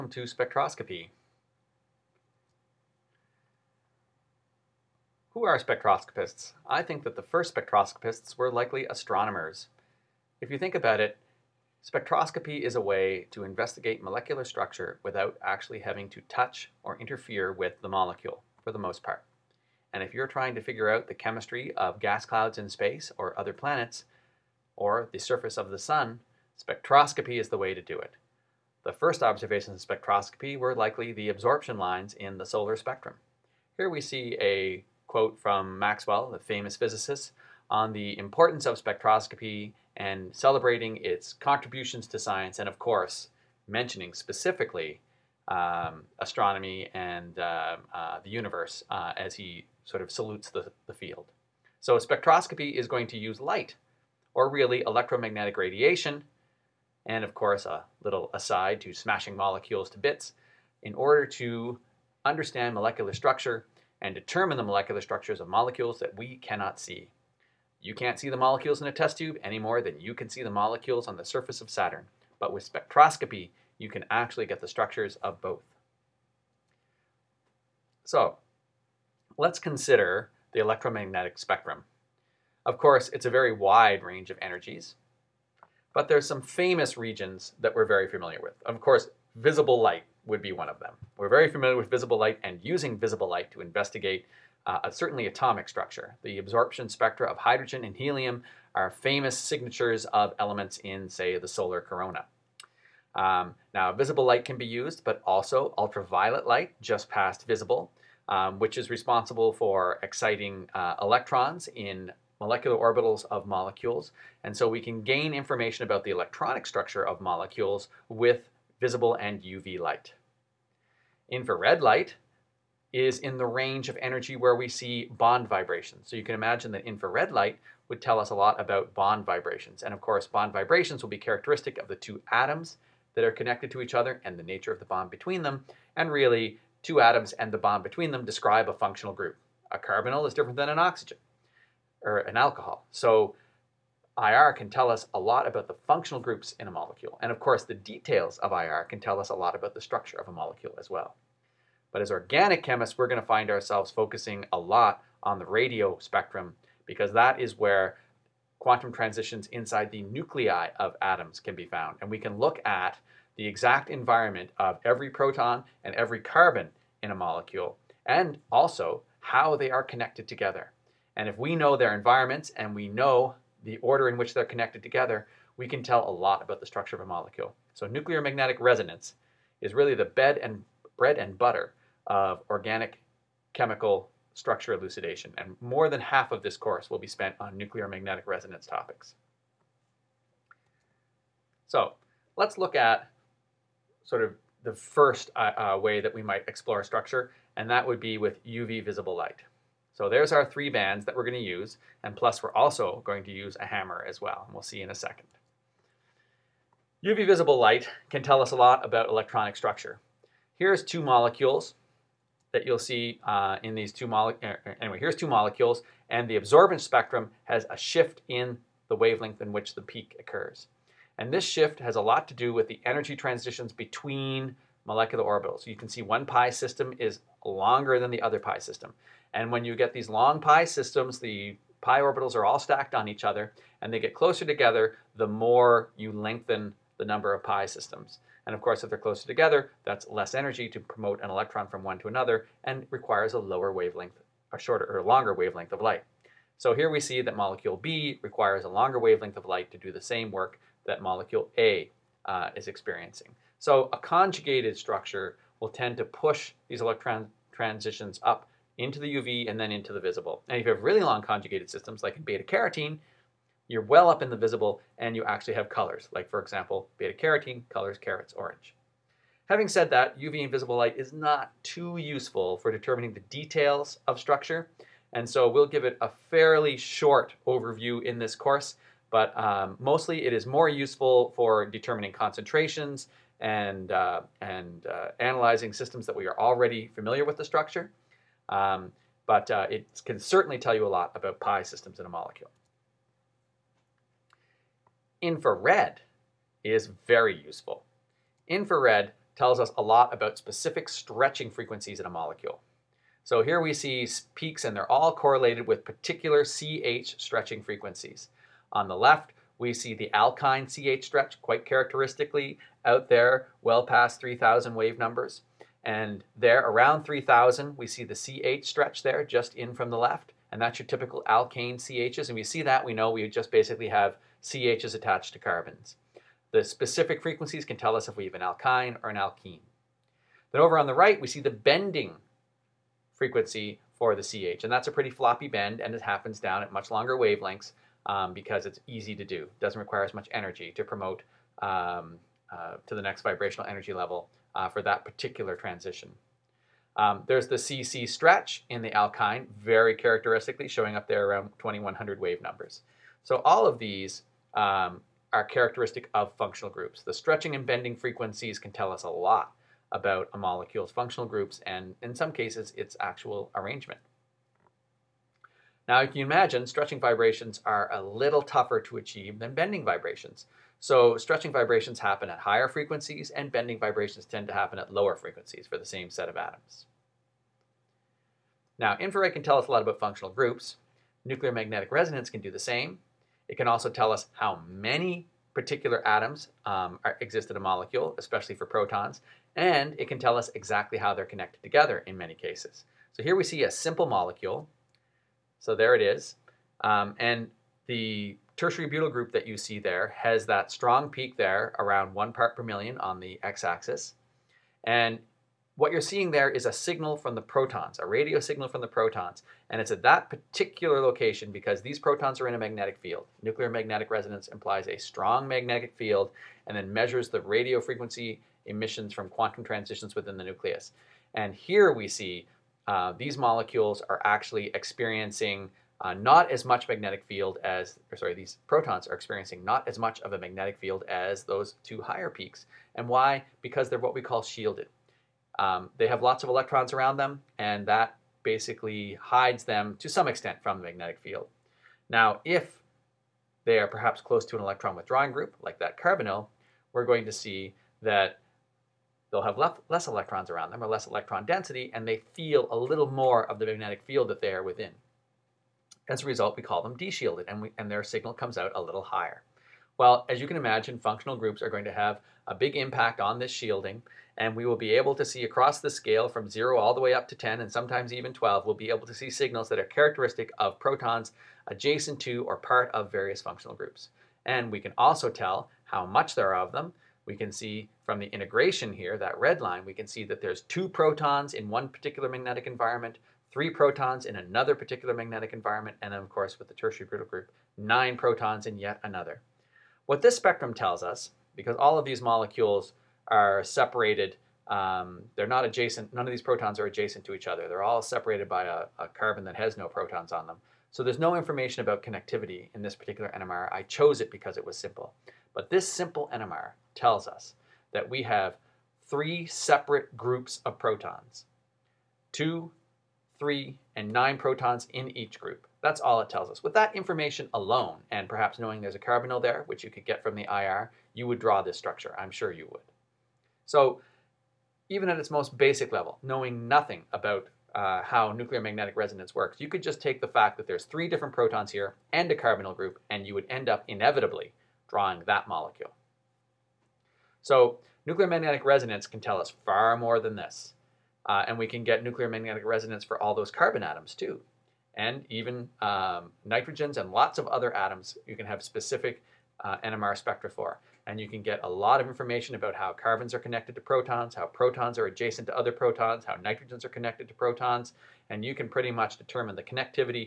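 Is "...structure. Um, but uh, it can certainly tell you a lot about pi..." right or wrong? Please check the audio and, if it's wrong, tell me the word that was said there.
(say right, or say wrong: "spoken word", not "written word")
right.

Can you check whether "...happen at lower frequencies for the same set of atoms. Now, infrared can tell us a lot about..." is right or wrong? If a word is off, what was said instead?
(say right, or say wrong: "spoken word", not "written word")
right.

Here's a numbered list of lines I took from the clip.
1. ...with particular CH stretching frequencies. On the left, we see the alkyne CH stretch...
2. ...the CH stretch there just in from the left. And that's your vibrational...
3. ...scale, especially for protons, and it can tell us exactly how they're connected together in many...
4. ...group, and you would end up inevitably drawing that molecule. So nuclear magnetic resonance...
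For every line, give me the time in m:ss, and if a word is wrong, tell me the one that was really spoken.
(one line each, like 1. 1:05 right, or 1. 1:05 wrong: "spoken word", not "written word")
1. 5:05 right
2. 5:18 wrong: "typical", not "vibrational"
3. 6:27 wrong: "molecule", not "scale"
4. 8:52 right.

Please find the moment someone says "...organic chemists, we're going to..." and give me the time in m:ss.
2:32.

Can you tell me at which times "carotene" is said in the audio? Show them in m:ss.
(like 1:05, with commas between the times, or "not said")
4:22, 4:27.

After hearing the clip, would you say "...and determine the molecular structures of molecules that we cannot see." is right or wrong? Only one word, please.
right.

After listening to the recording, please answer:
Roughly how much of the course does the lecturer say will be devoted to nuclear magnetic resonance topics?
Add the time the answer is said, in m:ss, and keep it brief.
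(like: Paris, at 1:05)
more than half, at 3:05.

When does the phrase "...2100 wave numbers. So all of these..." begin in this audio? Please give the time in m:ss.
5:51.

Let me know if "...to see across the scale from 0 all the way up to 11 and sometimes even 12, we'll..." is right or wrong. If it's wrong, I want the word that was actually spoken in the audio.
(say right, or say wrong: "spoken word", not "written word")
wrong: "10", not "11".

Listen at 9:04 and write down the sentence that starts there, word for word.
And even um, nitrogens and lots of other atoms you can have specific uh, NMR spectra for.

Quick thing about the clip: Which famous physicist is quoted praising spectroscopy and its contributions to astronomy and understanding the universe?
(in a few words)
Maxwell.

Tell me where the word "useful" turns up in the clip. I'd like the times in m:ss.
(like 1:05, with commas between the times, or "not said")
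4:31, 4:40, 4:57.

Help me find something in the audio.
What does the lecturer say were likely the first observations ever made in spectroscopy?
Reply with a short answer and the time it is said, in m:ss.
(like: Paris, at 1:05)
absorption lines in the solar spectrum, at 0:31.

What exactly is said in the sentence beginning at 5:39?
Doesn't require as much energy to promote um, uh, to the next vibrational energy level uh, for that particular transition.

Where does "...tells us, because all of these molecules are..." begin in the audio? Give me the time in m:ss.
8:10.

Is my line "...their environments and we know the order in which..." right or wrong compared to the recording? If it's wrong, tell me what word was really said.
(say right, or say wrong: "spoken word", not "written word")
right.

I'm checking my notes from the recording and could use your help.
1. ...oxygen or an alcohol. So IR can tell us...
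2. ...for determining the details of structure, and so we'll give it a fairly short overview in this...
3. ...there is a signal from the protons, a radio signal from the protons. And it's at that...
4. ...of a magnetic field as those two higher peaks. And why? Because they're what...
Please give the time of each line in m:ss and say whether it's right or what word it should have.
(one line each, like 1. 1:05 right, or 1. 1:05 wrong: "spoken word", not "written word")
1. 2:20 right
2. 4:32 right
3. 6:46 right
4. 7:10 right.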